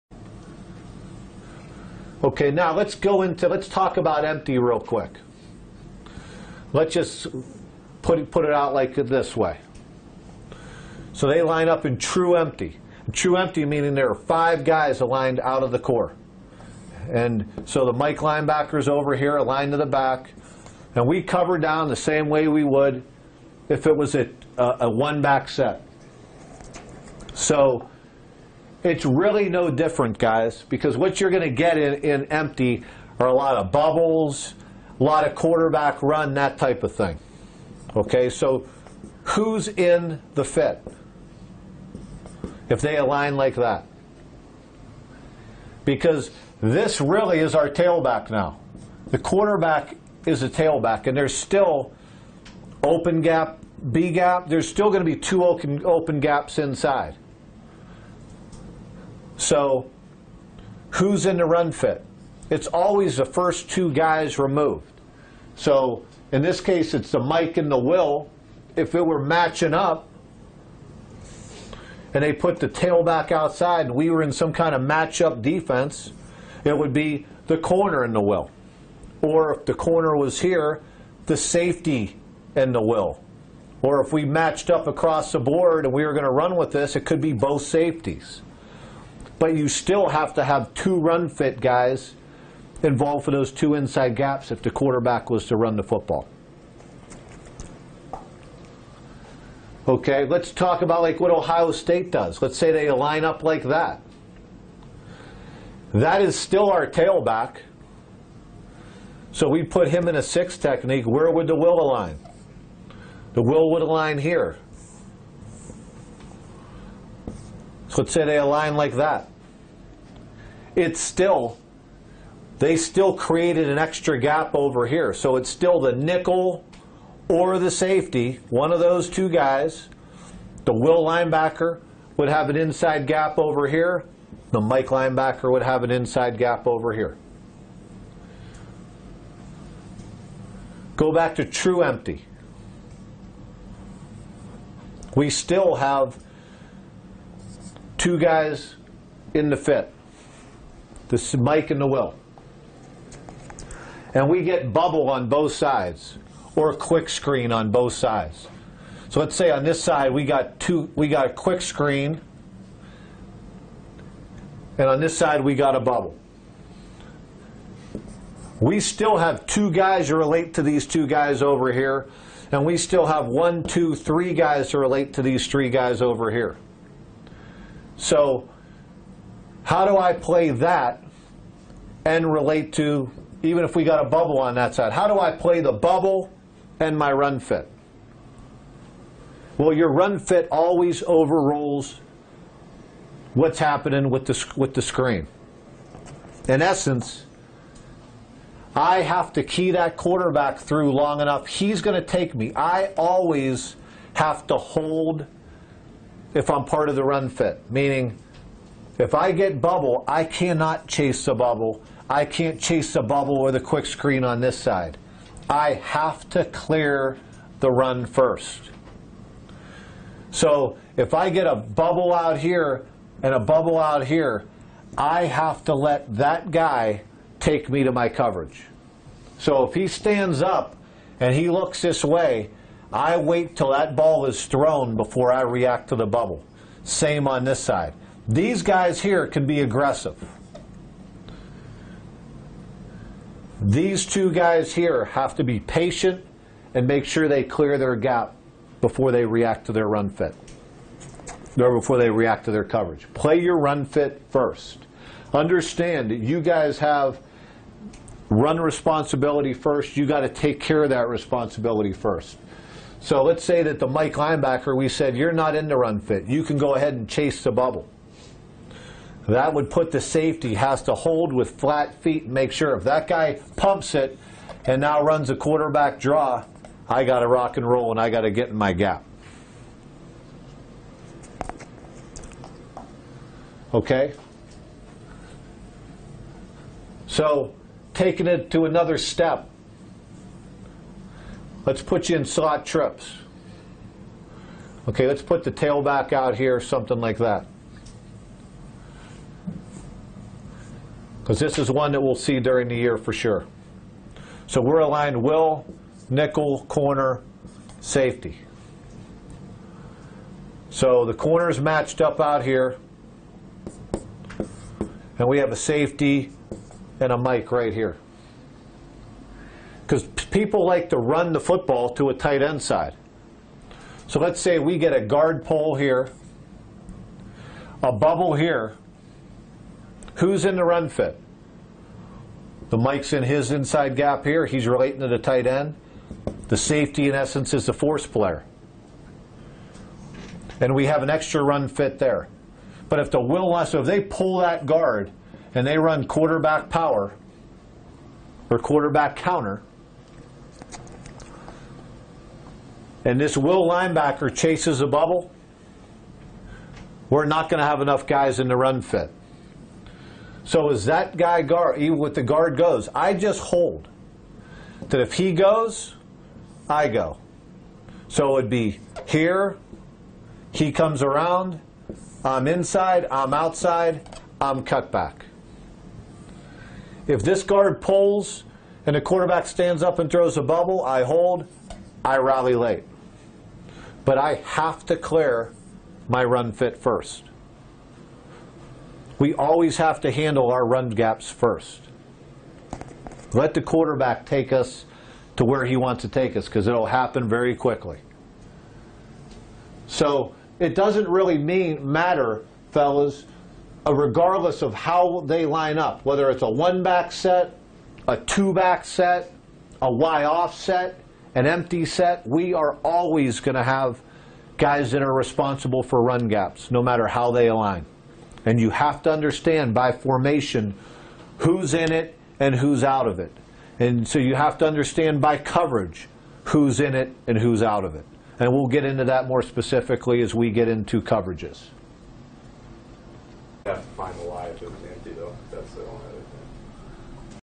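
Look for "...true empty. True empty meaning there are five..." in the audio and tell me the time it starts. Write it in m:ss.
0:11.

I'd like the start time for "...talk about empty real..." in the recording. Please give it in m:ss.
0:03.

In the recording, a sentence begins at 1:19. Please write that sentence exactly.
Or if the corner was here, the safety and the will.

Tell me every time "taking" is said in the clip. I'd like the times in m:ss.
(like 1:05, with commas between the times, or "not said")
4:47.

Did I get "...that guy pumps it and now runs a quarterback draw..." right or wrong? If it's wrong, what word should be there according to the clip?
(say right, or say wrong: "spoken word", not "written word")
right.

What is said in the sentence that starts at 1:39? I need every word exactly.
Okay, let's talk about like what Ohio State does.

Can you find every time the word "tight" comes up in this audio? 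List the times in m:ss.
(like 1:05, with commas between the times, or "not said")
5:22, 5:35.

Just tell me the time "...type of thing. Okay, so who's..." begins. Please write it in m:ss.
0:36.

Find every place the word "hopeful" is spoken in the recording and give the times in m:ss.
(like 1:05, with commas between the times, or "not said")
not said.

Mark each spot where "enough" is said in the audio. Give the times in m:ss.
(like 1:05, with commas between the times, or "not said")
3:21, 5:57.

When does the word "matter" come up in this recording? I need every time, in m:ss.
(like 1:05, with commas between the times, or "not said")
6:41, 6:56.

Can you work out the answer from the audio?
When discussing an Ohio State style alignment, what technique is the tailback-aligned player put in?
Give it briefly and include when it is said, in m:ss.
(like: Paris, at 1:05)
six technique, at 1:50.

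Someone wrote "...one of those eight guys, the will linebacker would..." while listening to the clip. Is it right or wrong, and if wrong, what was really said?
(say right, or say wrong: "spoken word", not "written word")
wrong: "two", not "eight".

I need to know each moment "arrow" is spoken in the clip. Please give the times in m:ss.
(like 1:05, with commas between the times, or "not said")
not said.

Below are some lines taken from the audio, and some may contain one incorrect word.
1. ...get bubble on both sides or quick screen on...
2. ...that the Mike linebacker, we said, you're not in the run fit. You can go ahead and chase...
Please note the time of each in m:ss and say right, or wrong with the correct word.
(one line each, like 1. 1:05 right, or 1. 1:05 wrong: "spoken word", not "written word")
1. 2:34 right
2. 4:23 right.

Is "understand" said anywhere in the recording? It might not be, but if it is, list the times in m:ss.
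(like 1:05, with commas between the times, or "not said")
4:15, 6:59, 7:04.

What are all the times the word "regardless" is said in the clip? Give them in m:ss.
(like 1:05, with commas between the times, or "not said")
6:43.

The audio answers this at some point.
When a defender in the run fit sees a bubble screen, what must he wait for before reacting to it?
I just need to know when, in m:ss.
3:53.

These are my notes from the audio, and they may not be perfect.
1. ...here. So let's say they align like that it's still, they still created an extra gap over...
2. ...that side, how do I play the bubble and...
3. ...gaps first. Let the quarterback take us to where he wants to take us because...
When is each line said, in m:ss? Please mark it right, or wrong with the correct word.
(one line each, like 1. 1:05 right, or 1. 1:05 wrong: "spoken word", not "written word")
1. 1:54 right
2. 3:04 right
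3. 6:30 right.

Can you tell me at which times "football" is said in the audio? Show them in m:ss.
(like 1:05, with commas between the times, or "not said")
1:35, 5:21.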